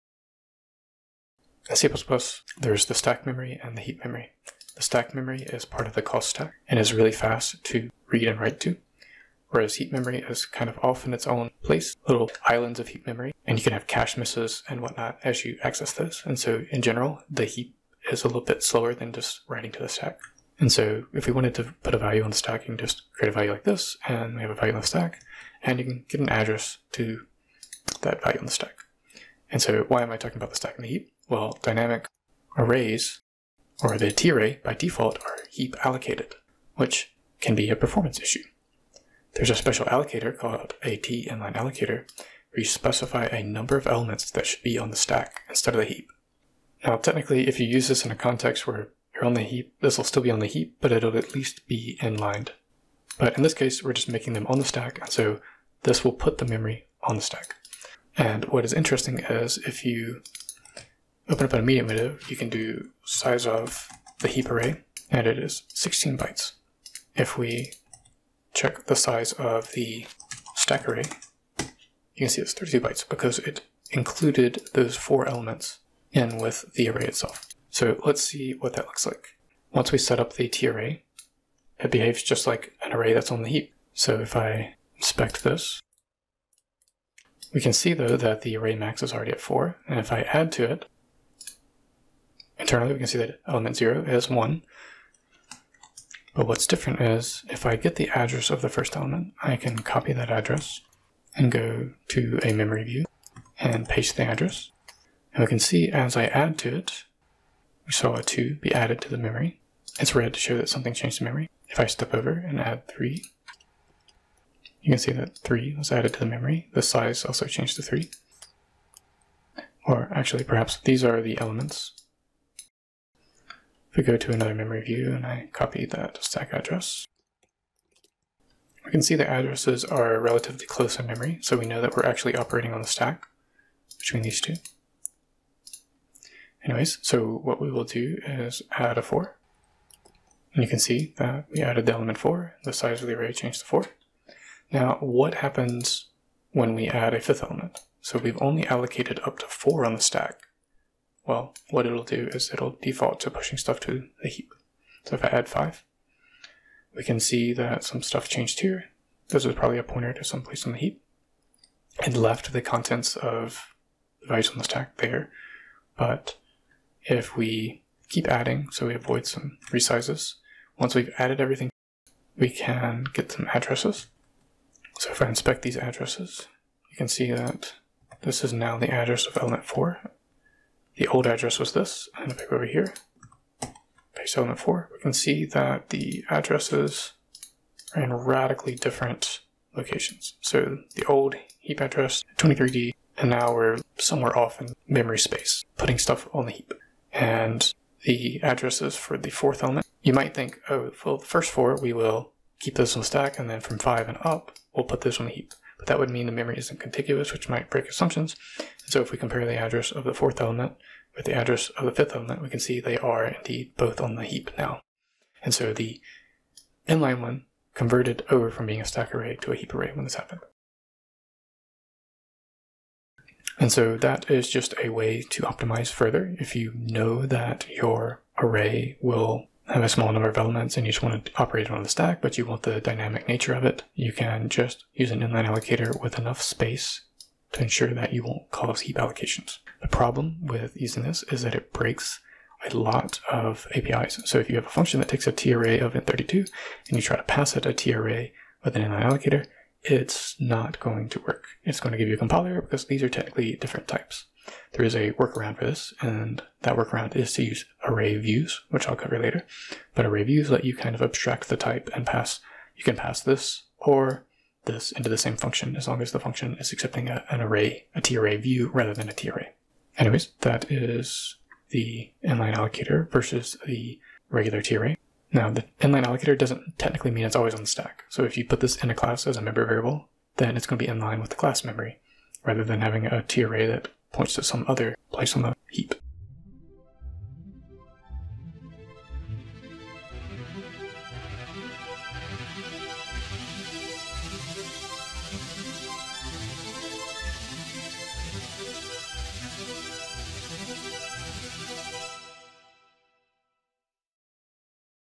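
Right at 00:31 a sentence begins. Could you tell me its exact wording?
well, dynamic arrays or the TArray by default are heap allocated, which can be a performance issue.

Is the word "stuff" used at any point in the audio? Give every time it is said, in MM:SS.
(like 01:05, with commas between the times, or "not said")
02:33, 02:38, 03:15.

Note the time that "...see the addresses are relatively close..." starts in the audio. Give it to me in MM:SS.
02:09.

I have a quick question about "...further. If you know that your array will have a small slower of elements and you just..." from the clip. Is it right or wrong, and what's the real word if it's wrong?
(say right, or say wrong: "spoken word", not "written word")
wrong: "number", not "slower".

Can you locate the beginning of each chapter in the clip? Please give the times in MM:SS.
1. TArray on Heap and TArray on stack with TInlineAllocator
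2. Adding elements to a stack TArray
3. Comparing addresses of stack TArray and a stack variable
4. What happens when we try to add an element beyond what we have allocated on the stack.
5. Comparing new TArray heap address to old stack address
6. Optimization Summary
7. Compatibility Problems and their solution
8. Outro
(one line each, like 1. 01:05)
1. 00:30
2. 01:20
3. 01:36
4. 02:23
5. 02:50
6. 03:45
7. 04:01
8. 04:45.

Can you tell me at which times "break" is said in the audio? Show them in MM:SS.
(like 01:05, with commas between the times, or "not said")
03:27, 04:01.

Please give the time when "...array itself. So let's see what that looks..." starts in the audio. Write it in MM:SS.
01:16.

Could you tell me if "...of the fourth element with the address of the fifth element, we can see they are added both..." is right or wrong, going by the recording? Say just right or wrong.
wrong.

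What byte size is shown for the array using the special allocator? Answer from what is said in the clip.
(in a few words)
32 bytes.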